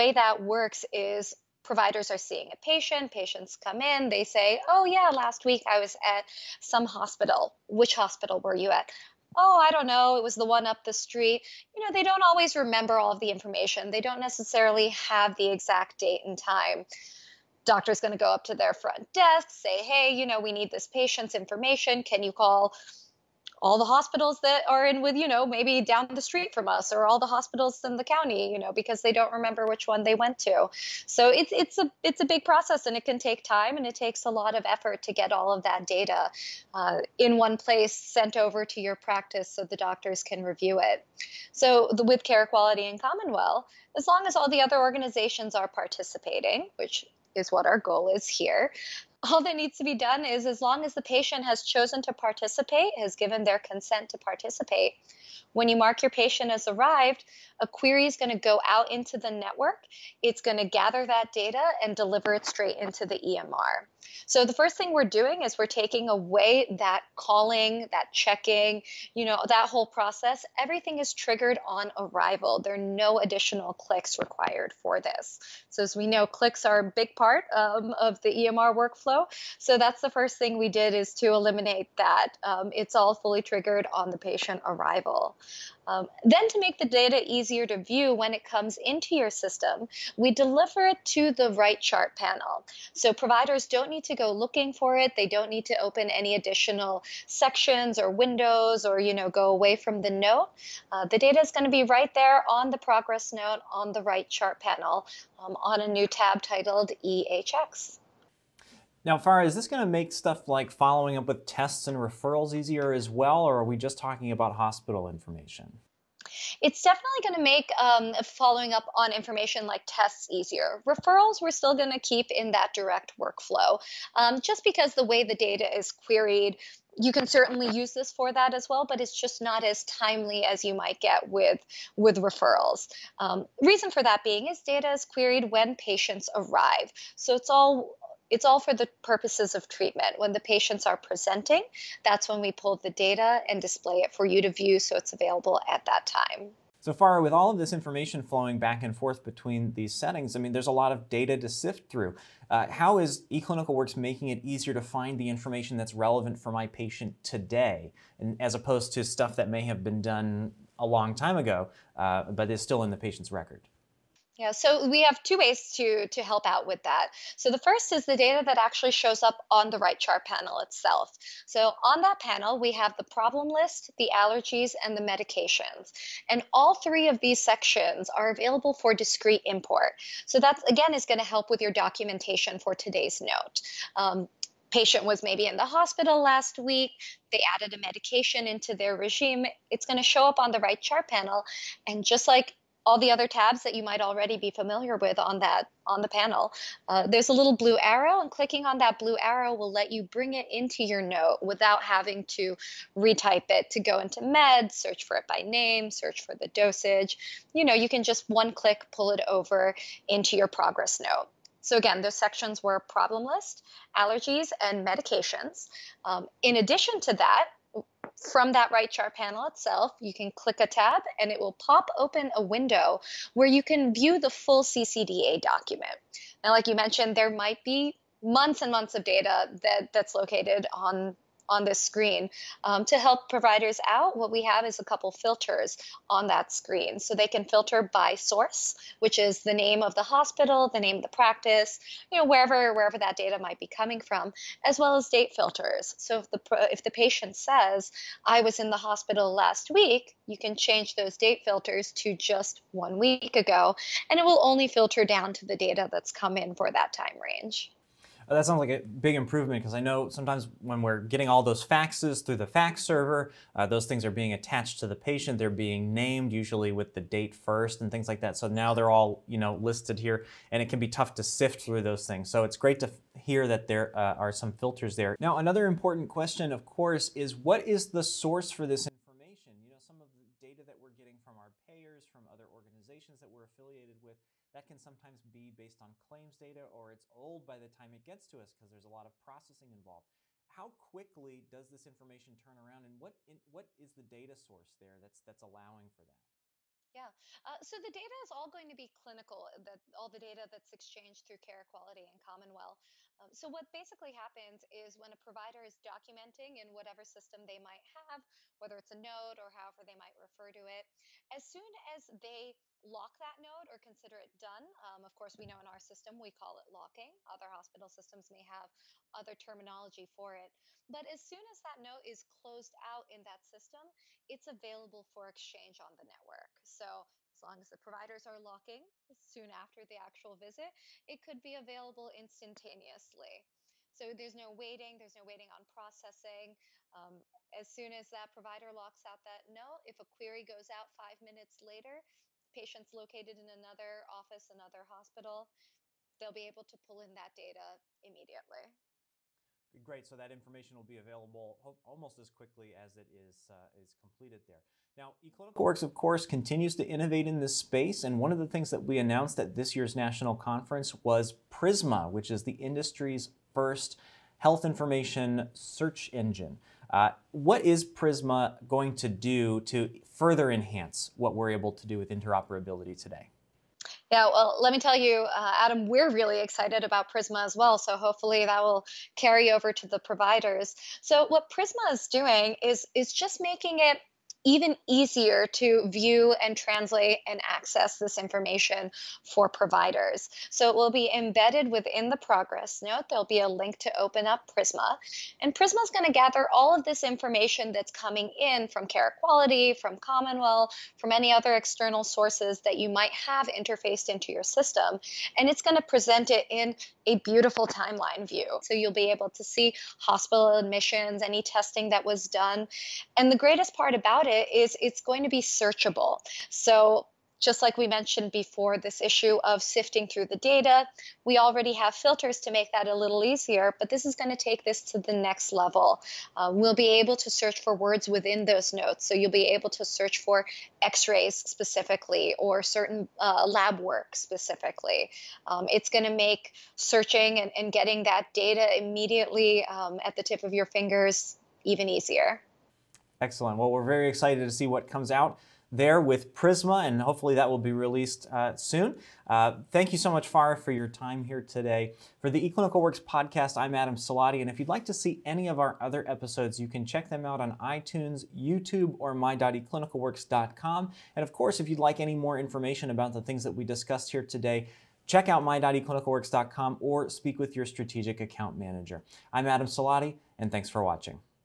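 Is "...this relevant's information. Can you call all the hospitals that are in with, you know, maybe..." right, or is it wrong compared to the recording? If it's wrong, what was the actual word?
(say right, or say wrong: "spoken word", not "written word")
wrong: "patient", not "relevant".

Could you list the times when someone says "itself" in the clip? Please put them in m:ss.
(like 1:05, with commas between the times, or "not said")
2:50, 3:39.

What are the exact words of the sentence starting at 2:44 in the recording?
Yeah, so we have two ways to to help out with that.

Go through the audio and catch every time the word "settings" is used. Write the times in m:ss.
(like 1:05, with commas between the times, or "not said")
2:29.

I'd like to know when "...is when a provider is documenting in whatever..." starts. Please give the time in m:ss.
5:04.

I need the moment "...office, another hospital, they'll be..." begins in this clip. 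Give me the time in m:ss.
5:44.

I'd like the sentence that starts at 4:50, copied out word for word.
How quickly does this information turn around and what, in, what is the data source there that's, that's allowing for that?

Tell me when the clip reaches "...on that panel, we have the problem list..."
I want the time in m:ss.
2:51.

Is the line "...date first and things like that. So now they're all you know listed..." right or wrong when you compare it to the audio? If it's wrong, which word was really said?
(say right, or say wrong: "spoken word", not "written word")
right.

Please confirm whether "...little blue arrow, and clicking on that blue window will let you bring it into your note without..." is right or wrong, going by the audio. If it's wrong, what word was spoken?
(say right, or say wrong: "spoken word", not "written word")
wrong: "arrow", not "window".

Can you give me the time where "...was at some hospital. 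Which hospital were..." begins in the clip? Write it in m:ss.
0:05.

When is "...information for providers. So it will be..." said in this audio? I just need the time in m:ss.
6:28.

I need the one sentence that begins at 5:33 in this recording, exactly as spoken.
So there's no waiting, there's no waiting on processing.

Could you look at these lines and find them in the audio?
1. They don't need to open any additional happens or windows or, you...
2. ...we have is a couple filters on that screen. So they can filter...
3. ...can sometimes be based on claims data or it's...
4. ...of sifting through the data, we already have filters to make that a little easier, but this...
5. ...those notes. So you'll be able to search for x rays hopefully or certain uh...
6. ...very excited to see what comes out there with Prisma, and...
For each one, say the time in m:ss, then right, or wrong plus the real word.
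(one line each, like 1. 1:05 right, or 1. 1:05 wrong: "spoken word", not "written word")
1. 1:35 wrong: "sections", not "happens"
2. 3:54 right
3. 4:44 right
4. 6:59 right
5. 7:08 wrong: "specifically", not "hopefully"
6. 7:23 right.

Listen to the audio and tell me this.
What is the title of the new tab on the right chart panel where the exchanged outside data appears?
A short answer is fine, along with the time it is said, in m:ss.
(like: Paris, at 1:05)
EHX, at 1:47.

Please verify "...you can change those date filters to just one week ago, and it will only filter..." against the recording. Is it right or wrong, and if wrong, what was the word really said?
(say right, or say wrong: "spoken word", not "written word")
right.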